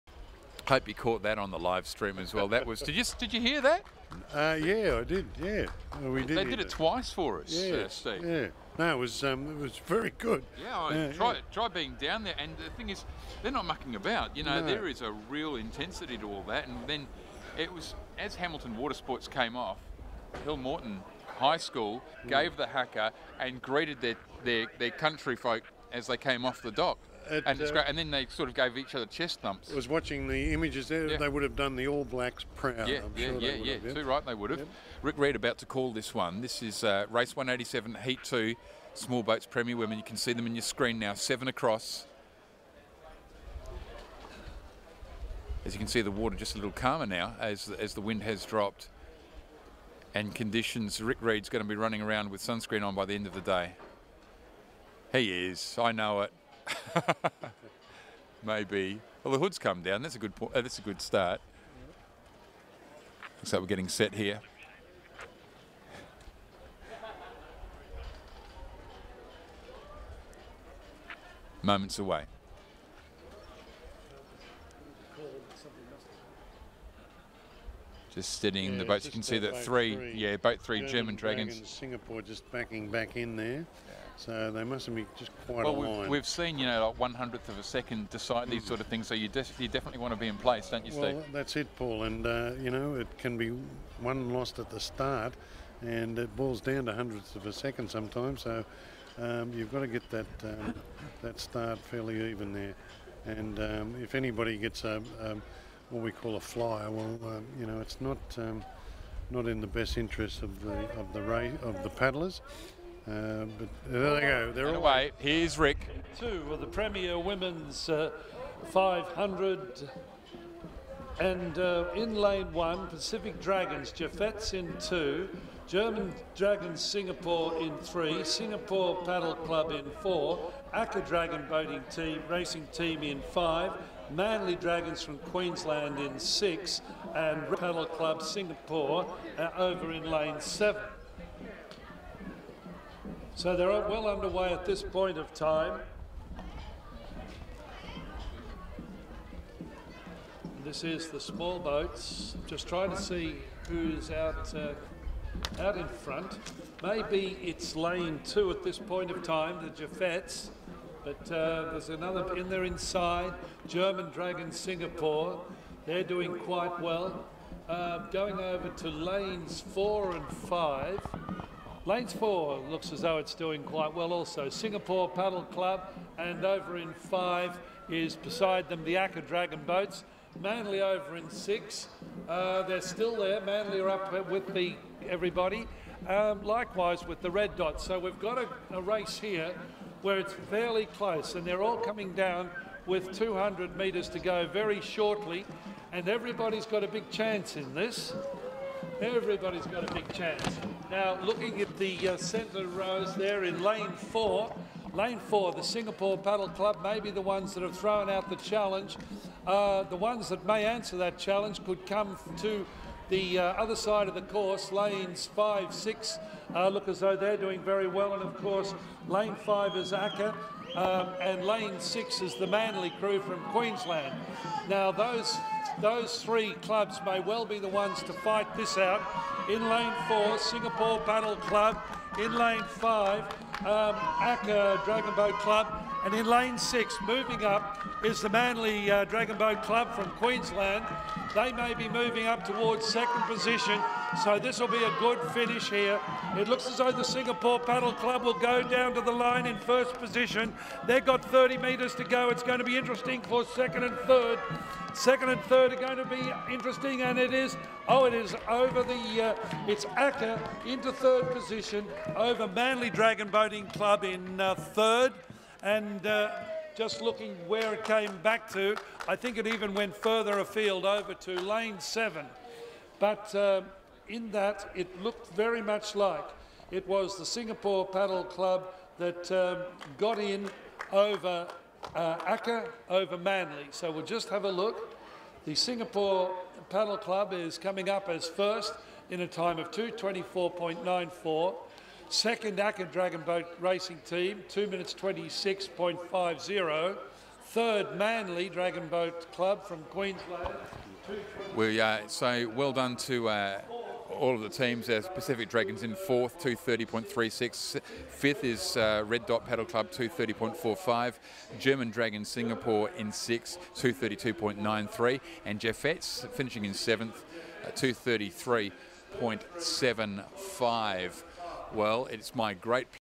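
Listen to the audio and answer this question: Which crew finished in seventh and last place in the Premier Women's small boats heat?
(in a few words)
Jeffettes.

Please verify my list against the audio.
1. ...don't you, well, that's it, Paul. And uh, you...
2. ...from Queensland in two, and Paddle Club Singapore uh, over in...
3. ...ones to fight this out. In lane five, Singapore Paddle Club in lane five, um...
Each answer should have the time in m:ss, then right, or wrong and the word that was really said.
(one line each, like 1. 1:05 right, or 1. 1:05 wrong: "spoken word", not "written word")
1. 1:30 right
2. 2:15 wrong: "six", not "two"
3. 3:47 wrong: "four", not "five".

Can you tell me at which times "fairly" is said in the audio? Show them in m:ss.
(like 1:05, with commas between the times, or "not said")
1:41, 3:10.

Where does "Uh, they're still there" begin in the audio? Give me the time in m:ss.
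3:02.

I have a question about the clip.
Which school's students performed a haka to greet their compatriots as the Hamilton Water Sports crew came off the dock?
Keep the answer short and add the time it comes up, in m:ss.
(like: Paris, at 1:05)
Hillmorton High School, at 0:20.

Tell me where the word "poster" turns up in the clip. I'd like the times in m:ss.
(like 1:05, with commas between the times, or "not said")
not said.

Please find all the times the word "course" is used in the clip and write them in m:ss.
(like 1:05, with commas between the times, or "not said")
3:34, 3:38.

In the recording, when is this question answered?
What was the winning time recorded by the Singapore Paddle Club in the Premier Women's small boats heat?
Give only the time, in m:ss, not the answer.
4:49.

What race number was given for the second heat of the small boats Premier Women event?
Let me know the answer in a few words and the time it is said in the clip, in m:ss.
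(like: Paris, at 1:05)
187, at 0:37.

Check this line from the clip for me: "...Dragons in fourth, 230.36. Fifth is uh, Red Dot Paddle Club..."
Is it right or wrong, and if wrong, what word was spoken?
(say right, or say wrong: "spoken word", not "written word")
right.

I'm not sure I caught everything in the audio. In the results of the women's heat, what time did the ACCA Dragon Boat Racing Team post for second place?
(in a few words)
2:26.50.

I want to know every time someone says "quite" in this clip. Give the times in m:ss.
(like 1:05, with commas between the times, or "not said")
1:25, 2:46, 2:53.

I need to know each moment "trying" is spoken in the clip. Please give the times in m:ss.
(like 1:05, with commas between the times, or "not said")
2:32.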